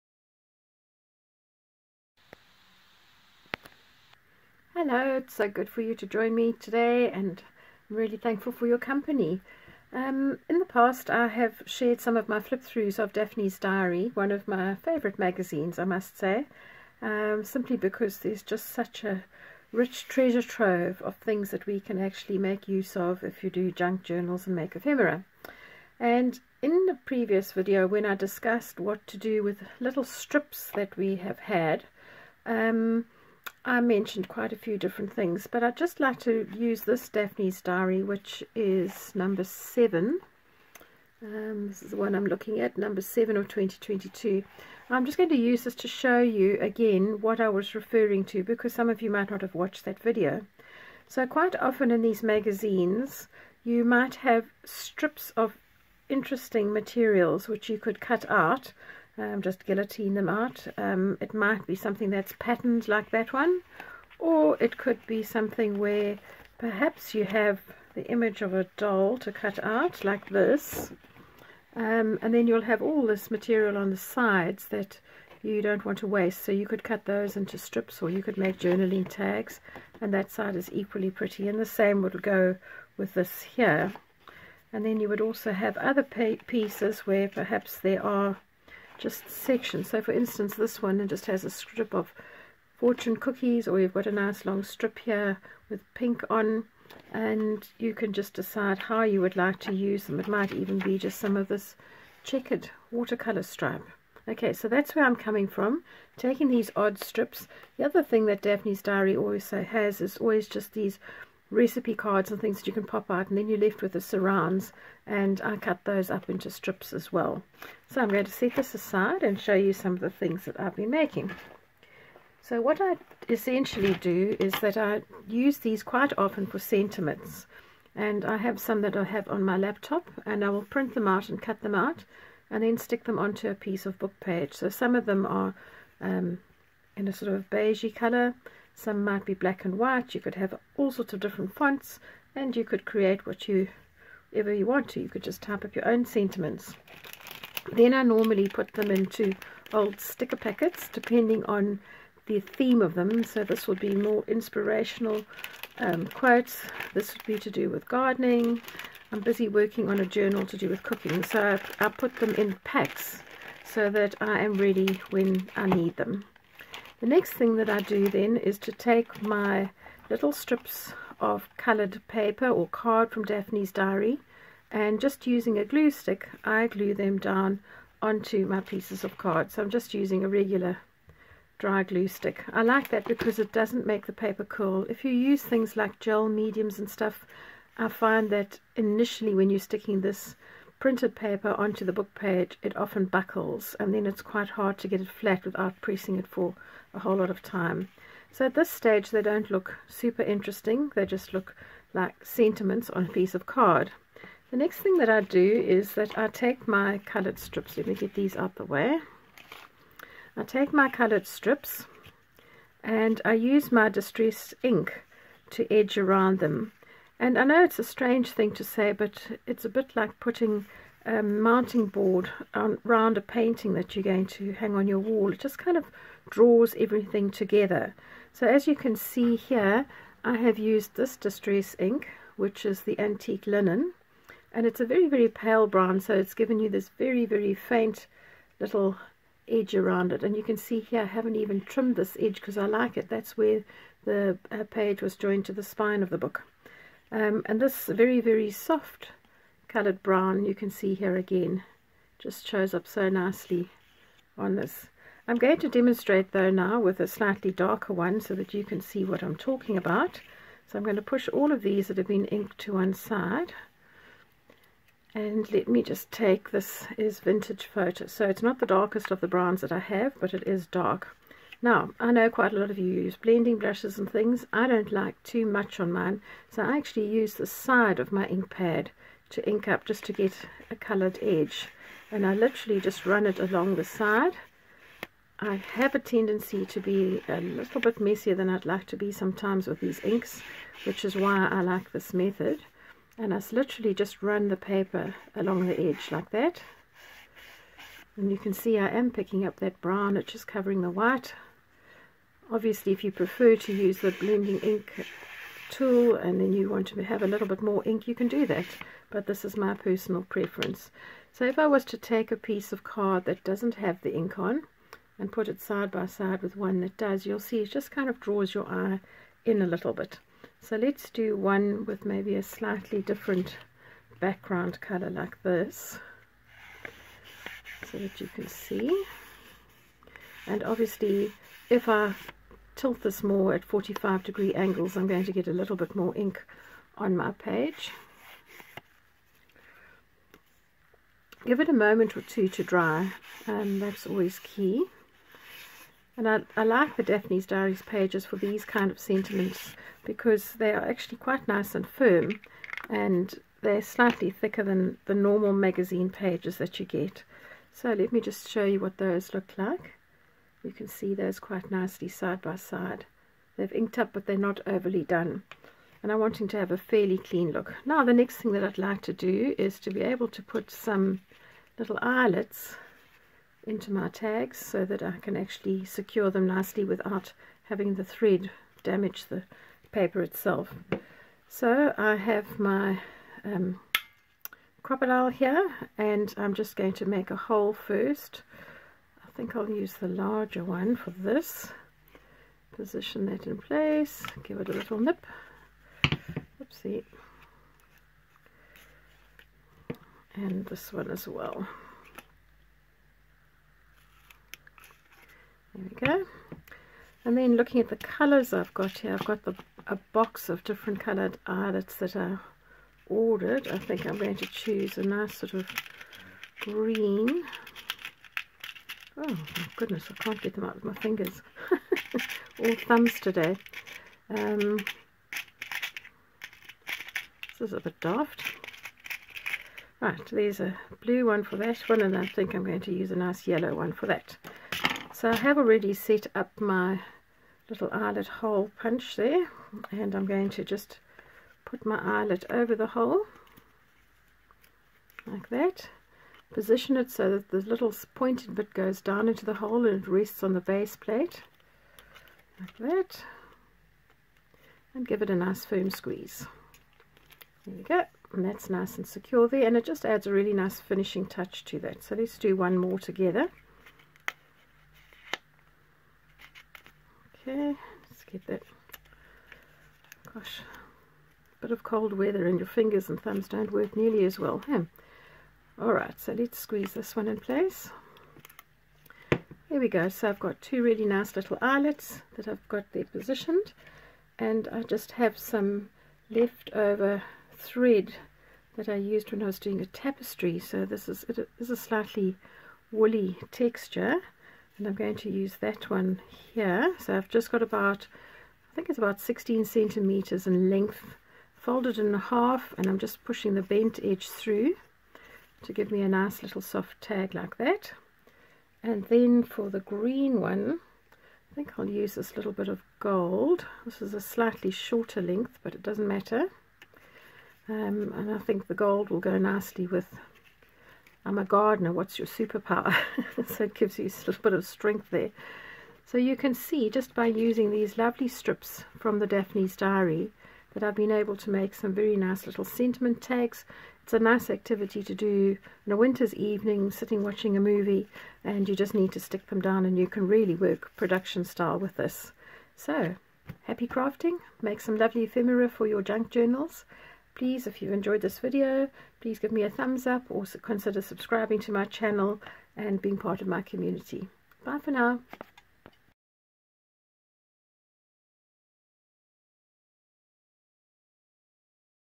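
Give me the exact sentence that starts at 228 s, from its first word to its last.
So as you can see here, I have used this Distress ink, which is the Antique Linen.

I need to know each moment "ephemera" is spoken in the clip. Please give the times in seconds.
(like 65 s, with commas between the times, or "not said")
24 s, 545 s.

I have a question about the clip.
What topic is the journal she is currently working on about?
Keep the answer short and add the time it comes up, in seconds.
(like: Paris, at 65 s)
Cooking, at 160 s.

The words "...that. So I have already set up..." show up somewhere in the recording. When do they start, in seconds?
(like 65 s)
434 s.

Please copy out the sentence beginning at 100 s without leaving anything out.
It might even be just some of this checkered watercolour stripe.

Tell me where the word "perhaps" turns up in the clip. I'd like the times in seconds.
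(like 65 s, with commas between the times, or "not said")
66 s, 87 s.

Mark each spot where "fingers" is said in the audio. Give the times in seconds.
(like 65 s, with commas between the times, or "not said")
420 s, 472 s.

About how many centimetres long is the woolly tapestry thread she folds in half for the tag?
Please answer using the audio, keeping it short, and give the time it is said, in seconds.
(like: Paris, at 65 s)
16 centimeters, at 499 s.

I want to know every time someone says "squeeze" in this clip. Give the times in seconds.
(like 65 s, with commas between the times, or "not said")
455 s, 476 s.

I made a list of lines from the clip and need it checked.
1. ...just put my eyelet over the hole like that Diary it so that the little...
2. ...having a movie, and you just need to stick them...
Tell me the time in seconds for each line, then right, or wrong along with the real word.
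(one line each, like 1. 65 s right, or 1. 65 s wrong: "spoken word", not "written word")
1. 440 s wrong: "Position", not "Diary"
2. 537 s wrong: "watching", not "having".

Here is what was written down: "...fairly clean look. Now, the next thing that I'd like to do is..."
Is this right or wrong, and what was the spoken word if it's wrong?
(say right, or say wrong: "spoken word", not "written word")
right.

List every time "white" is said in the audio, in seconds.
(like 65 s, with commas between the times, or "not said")
139 s, 300 s.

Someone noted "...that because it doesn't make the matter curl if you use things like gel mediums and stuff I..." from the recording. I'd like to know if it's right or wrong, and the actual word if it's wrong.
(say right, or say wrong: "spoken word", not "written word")
wrong: "paper", not "matter".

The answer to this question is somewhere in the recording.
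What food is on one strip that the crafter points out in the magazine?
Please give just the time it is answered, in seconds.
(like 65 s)
92 s.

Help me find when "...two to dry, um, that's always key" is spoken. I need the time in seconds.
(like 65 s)
342 s.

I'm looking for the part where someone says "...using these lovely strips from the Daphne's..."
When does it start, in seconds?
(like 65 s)
527 s.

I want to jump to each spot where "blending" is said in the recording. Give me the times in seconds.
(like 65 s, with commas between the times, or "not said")
273 s, 304 s.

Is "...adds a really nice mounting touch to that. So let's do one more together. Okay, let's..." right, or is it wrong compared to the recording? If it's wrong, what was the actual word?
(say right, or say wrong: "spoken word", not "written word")
wrong: "finishing", not "mounting".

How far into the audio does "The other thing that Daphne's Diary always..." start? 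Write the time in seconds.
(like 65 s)
107 s.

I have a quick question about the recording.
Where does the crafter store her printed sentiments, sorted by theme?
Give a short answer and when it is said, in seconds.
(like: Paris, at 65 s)
Old sticker packets, at 149 s.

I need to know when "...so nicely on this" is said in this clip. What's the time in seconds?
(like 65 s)
252 s.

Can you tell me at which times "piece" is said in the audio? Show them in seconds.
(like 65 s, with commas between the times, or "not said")
86 s, 133 s, 178 s, 203 s, 312 s.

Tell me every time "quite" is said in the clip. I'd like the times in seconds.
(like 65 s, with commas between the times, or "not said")
34 s, 51 s, 125 s, 194 s, 272 s, 351 s, 361 s.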